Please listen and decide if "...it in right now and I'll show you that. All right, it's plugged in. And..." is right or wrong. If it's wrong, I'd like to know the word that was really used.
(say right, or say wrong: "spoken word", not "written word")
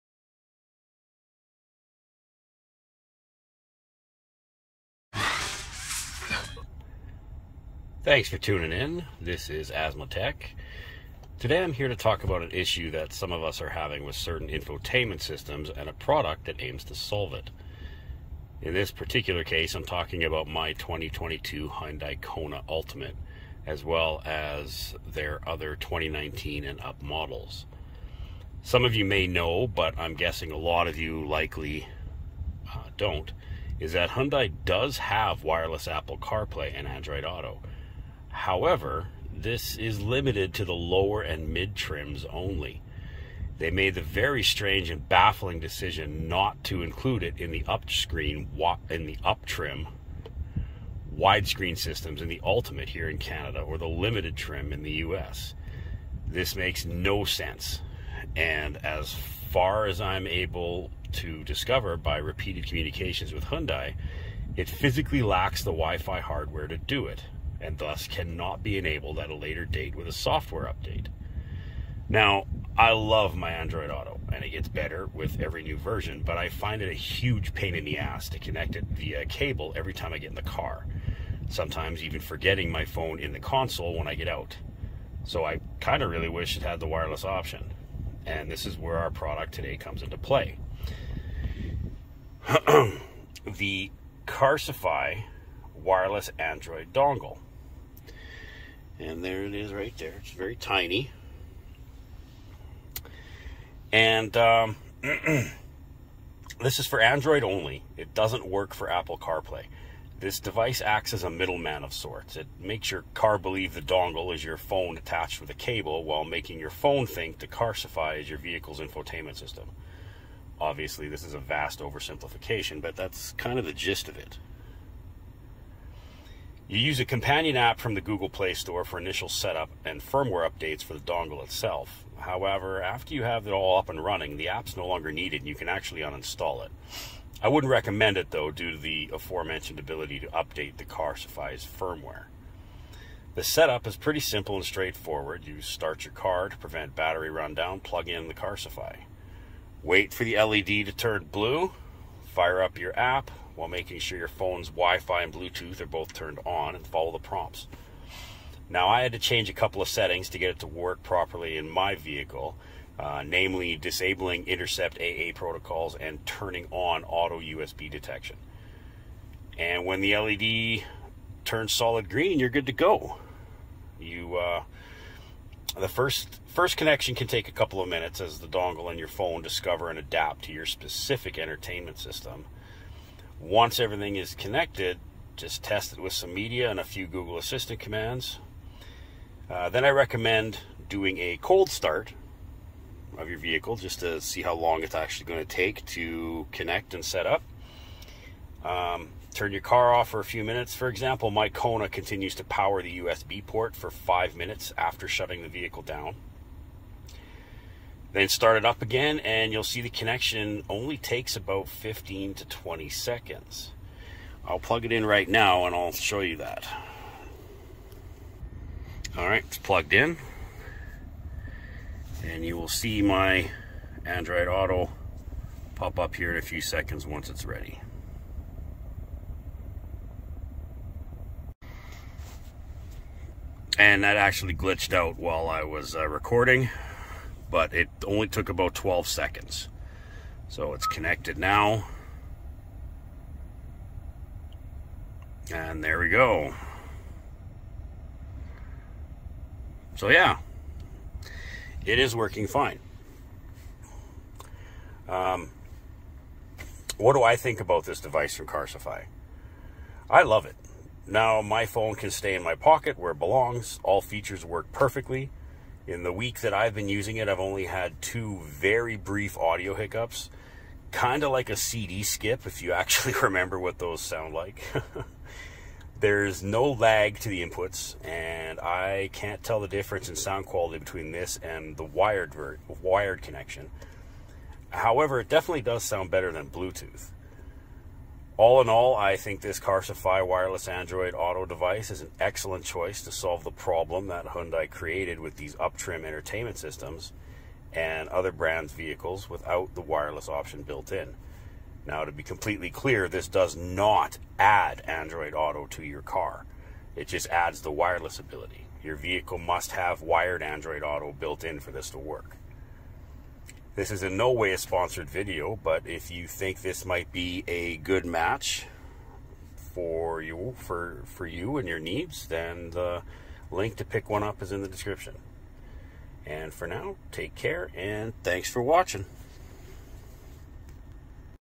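right.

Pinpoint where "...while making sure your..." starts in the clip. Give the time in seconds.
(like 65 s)
153 s.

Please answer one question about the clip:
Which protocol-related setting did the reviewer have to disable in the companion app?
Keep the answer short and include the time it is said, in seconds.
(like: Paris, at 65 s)
Intercept AA protocols, at 164 s.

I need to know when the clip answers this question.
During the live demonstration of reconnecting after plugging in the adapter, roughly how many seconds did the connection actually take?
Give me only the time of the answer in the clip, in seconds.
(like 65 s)
238 s.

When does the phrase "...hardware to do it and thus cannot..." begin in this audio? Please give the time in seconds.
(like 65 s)
66 s.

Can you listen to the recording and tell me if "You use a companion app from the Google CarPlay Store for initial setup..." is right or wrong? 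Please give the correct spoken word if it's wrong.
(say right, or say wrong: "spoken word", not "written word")
wrong: "Play", not "CarPlay".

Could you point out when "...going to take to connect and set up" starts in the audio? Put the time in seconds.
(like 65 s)
195 s.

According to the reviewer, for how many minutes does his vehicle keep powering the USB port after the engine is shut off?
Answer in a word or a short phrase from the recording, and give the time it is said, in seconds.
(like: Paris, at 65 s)
5 minutes, at 203 s.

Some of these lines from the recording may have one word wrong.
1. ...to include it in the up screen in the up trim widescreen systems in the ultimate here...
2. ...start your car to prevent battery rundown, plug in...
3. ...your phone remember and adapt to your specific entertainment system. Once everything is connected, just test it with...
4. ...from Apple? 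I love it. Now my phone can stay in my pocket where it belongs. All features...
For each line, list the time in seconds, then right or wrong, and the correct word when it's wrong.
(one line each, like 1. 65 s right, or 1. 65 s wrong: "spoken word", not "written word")
1. 46 s right
2. 145 s right
3. 178 s wrong: "discover", not "remember"
4. 258 s wrong: "Carsifi", not "Apple".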